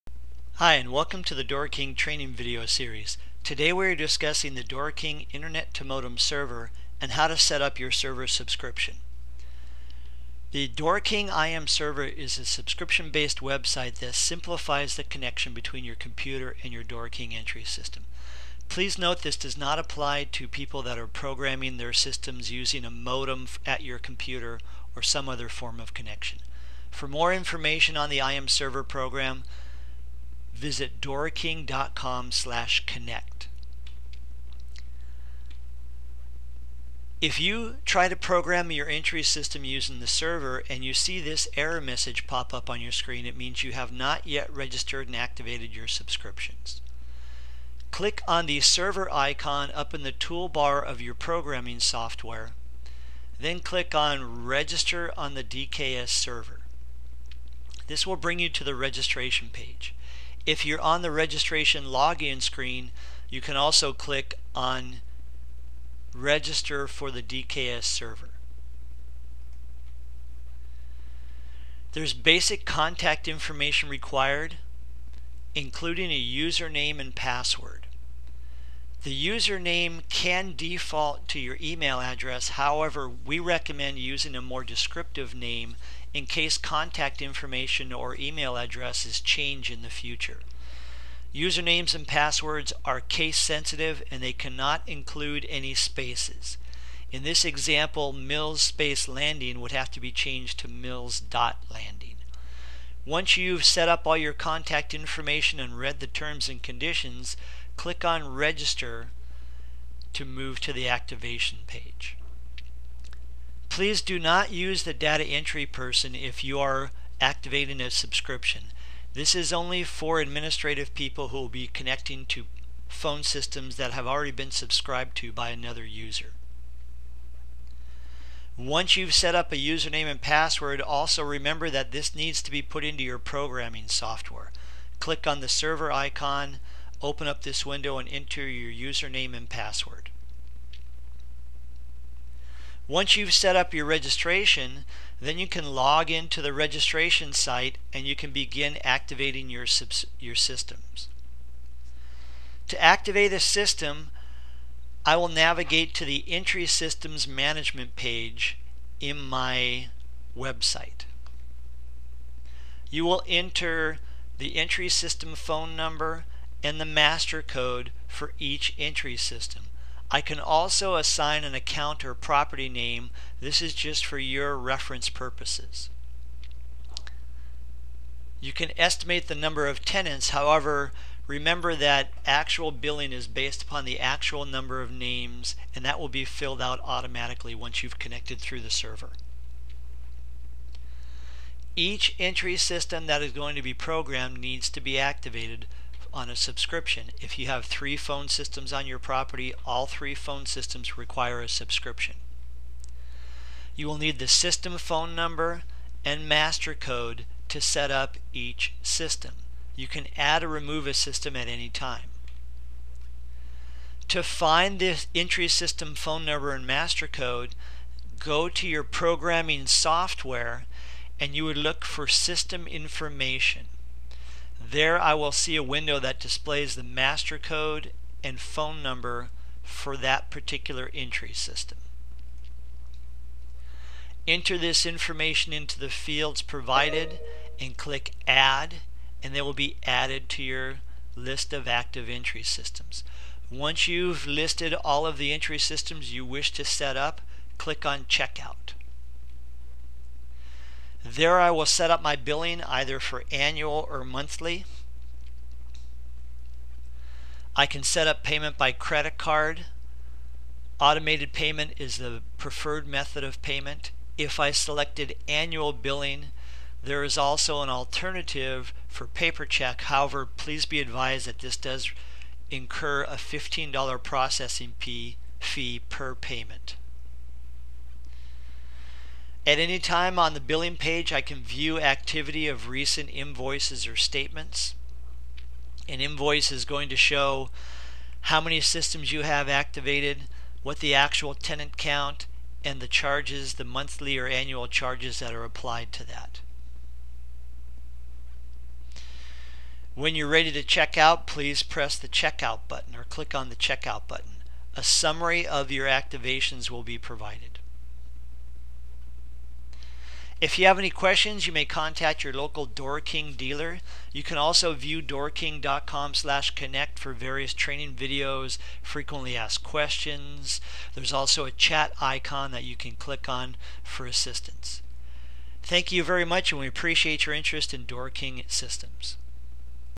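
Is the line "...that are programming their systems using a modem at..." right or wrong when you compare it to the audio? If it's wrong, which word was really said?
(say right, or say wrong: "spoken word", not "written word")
right.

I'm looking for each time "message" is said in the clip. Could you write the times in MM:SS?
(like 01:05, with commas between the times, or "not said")
00:41.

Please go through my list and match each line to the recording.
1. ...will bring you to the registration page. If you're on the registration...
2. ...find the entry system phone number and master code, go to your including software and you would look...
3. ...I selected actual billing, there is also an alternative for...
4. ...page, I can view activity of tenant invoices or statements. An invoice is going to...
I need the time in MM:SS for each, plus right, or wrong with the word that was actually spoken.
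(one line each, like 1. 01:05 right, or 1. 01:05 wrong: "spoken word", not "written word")
1. 00:58 right
2. 03:34 wrong: "programming", not "including"
3. 04:24 wrong: "annual", not "actual"
4. 04:40 wrong: "recent", not "tenant".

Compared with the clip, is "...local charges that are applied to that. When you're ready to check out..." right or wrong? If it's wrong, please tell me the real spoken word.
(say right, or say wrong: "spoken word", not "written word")
wrong: "annual", not "local".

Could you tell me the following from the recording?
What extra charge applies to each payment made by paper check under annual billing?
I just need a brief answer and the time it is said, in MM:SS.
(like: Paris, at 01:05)
$15, at 04:33.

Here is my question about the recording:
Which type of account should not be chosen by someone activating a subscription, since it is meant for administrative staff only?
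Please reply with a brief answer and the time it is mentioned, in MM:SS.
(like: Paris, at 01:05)
data entry person, at 01:54.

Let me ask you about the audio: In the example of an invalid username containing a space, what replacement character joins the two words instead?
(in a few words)
dot.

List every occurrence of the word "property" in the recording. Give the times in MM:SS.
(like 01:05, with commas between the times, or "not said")
02:52, 03:18.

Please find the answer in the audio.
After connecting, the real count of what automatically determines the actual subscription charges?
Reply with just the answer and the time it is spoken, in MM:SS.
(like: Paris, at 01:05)
names, at 03:04.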